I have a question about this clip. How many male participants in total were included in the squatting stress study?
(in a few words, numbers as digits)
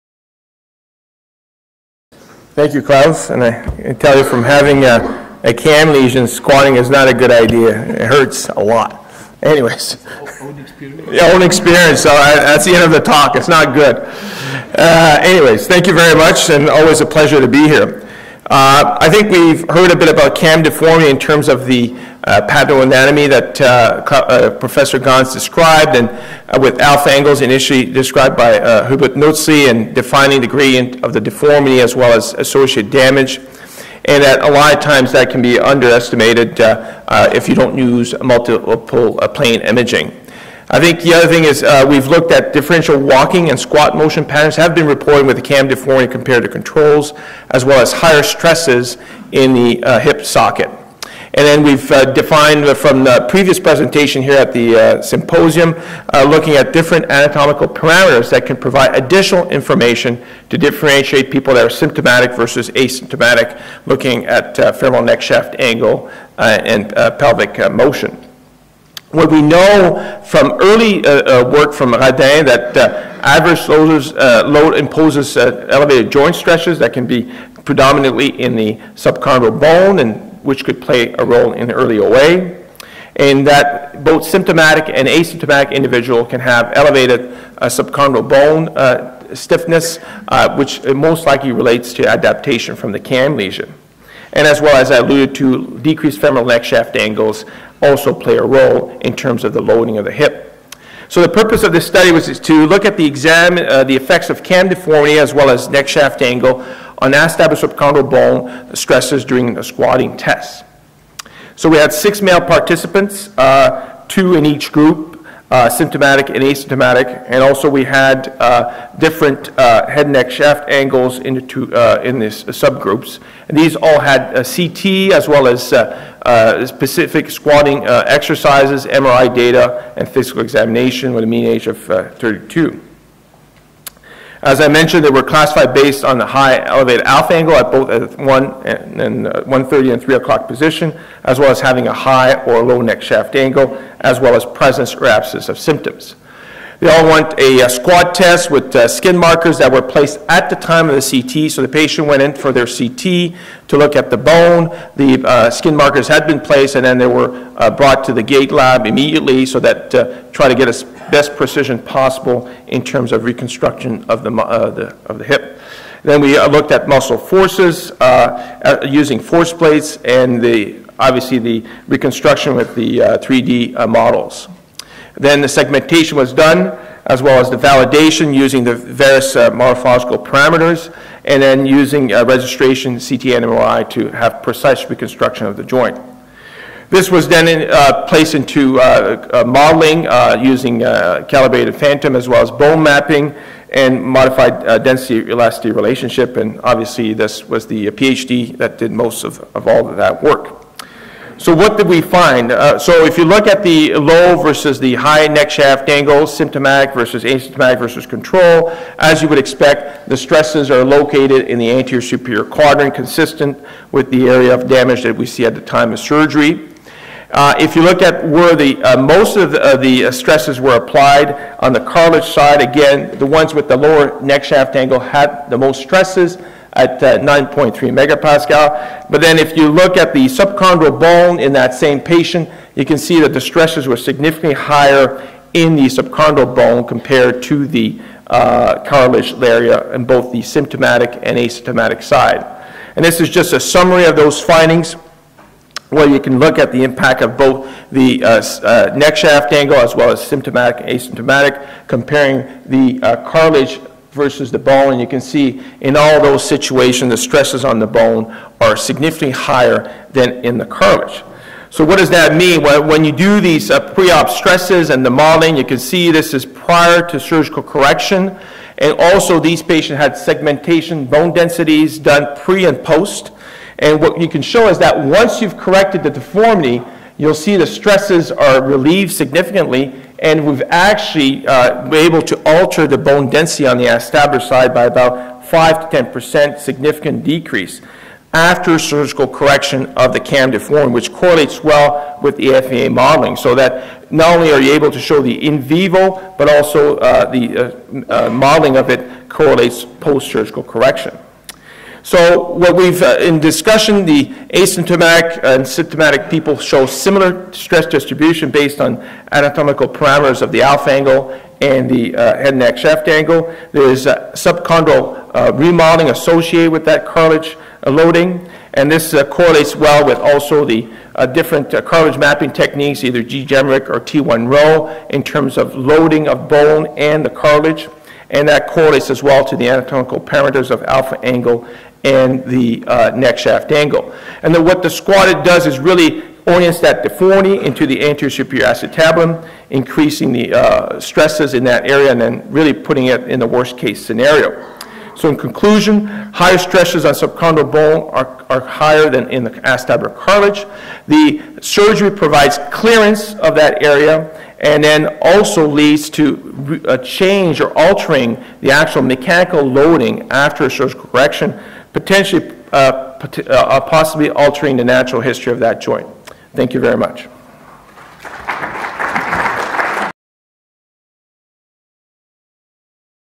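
6.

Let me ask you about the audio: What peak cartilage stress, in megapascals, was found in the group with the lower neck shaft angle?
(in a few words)
9.3.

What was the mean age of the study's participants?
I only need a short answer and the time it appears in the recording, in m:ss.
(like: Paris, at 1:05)
32, at 2:11.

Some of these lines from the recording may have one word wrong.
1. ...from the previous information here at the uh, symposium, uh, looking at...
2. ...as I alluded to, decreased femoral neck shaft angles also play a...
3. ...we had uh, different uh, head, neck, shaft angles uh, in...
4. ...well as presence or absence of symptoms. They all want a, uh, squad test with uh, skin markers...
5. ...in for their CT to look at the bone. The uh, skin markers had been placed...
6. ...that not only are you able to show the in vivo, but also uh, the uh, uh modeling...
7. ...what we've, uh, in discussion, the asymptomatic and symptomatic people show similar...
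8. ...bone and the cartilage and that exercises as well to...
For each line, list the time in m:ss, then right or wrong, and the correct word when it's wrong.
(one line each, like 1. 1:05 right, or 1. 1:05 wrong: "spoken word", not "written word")
1. 0:52 wrong: "presentation", not "information"
2. 1:34 right
3. 1:57 right
4. 2:24 right
5. 2:32 right
6. 4:53 right
7. 5:02 right
8. 5:26 wrong: "correlates", not "exercises".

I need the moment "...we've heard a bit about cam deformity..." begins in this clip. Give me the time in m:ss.
0:19.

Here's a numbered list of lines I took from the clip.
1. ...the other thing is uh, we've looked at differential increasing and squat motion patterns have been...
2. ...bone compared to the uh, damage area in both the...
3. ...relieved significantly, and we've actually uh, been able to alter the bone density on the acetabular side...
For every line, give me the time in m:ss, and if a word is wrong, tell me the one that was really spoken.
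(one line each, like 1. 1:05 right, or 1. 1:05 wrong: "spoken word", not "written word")
1. 0:41 wrong: "walking", not "increasing"
2. 3:56 wrong: "cartilage", not "damage"
3. 4:38 right.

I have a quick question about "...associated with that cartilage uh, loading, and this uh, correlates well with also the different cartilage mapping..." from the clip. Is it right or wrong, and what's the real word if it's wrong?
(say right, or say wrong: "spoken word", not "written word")
right.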